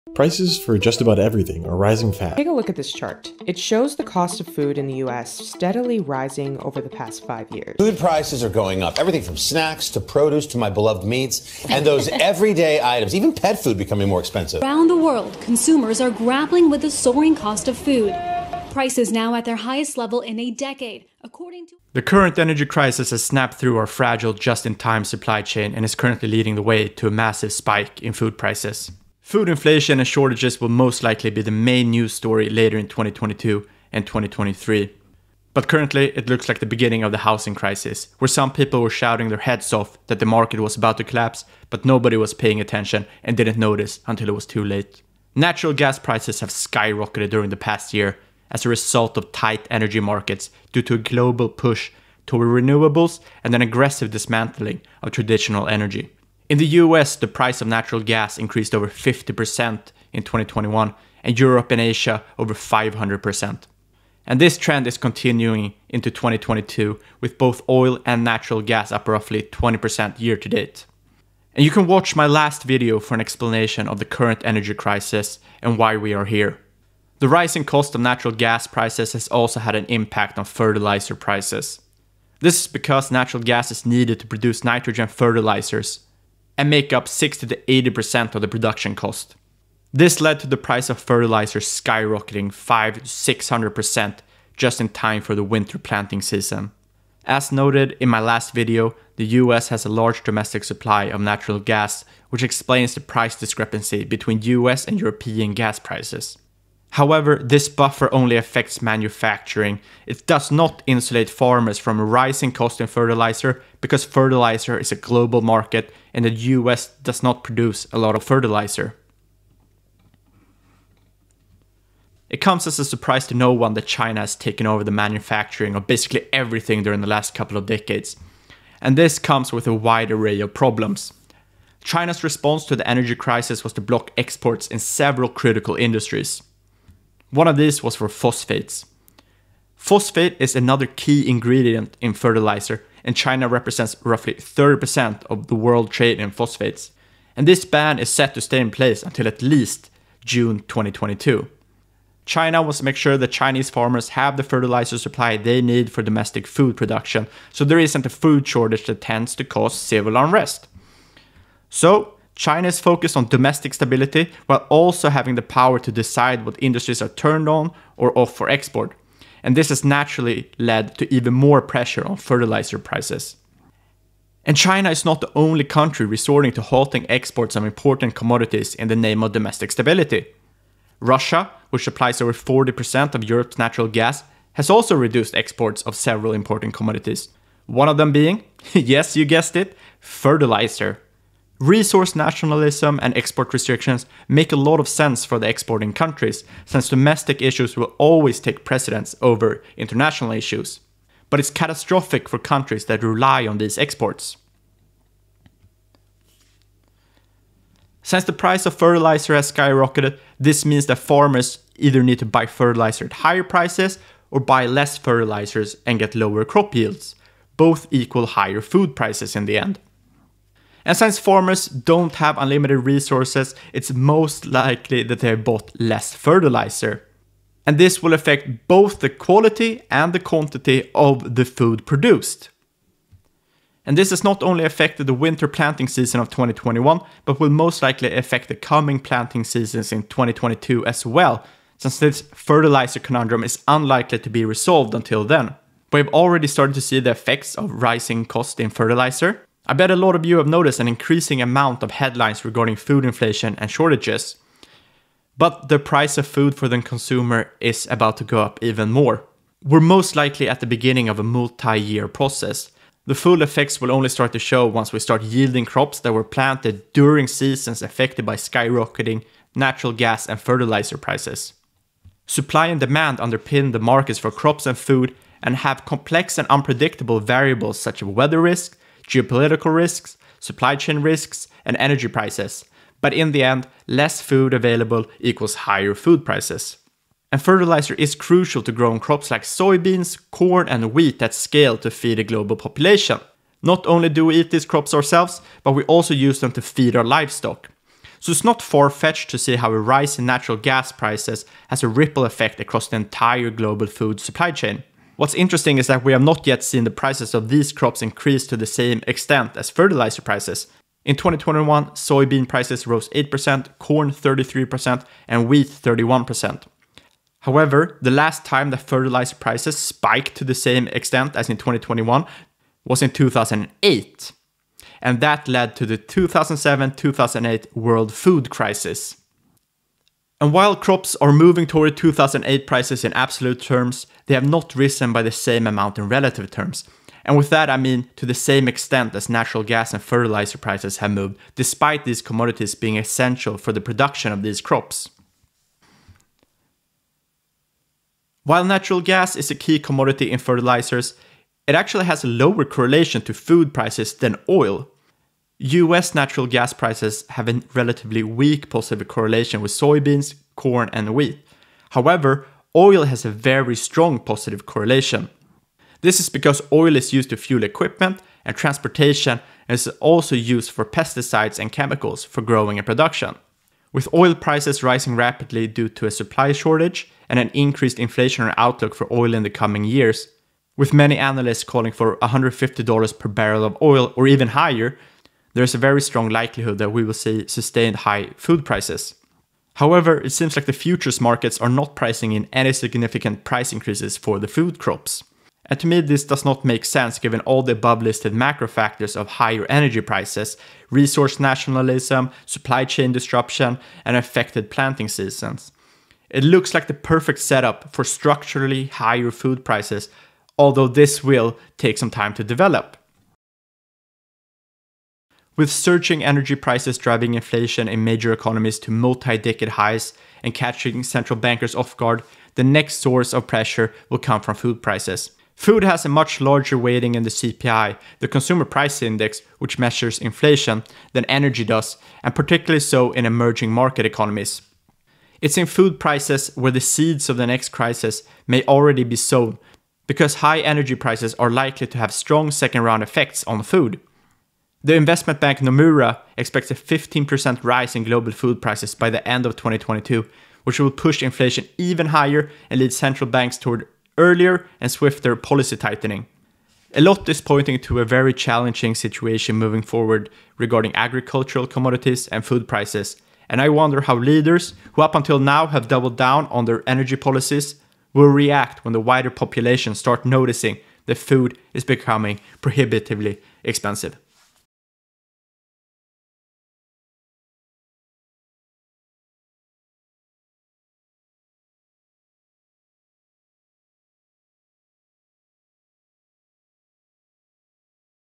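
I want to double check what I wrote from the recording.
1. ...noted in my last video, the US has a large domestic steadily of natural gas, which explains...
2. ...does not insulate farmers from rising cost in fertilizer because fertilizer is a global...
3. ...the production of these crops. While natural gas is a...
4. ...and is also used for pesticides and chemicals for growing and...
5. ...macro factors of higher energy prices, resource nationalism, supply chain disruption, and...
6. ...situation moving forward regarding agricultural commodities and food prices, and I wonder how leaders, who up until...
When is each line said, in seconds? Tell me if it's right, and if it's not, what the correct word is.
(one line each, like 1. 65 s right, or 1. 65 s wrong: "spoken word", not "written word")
1. 97 s wrong: "supply", not "steadily"
2. 110 s right
3. 343 s right
4. 369 s right
5. 398 s right
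6. 458 s right.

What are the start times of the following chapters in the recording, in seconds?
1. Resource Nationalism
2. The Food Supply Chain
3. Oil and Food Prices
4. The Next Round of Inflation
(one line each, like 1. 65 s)
1. 120 s
2. 205 s
3. 347 s
4. 414 s.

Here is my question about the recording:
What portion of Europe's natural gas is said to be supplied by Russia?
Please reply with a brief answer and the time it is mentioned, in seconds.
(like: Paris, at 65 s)
over 40%, at 182 s.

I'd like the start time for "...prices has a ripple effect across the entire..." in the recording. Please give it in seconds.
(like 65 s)
300 s.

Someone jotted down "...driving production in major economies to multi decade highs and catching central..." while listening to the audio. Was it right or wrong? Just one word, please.
wrong.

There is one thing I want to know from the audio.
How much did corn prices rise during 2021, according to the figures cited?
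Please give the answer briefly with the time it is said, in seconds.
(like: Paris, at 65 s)
33%, at 313 s.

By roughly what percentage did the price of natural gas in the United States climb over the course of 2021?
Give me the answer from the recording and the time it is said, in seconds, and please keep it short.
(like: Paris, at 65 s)
over 50%, at 58 s.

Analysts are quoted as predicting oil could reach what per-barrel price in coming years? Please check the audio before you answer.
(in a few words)
$150.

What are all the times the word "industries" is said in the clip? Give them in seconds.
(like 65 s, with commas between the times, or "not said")
135 s, 166 s.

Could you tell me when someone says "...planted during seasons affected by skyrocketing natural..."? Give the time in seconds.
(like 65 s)
266 s.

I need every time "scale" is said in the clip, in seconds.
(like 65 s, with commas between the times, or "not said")
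291 s.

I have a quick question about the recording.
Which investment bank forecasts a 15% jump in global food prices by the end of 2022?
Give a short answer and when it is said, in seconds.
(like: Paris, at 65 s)
Nomura, at 445 s.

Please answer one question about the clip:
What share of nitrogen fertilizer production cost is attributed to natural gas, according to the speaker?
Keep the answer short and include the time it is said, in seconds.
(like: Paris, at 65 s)
60 to 80%, at 87 s.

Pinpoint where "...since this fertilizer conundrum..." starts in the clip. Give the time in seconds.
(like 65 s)
241 s.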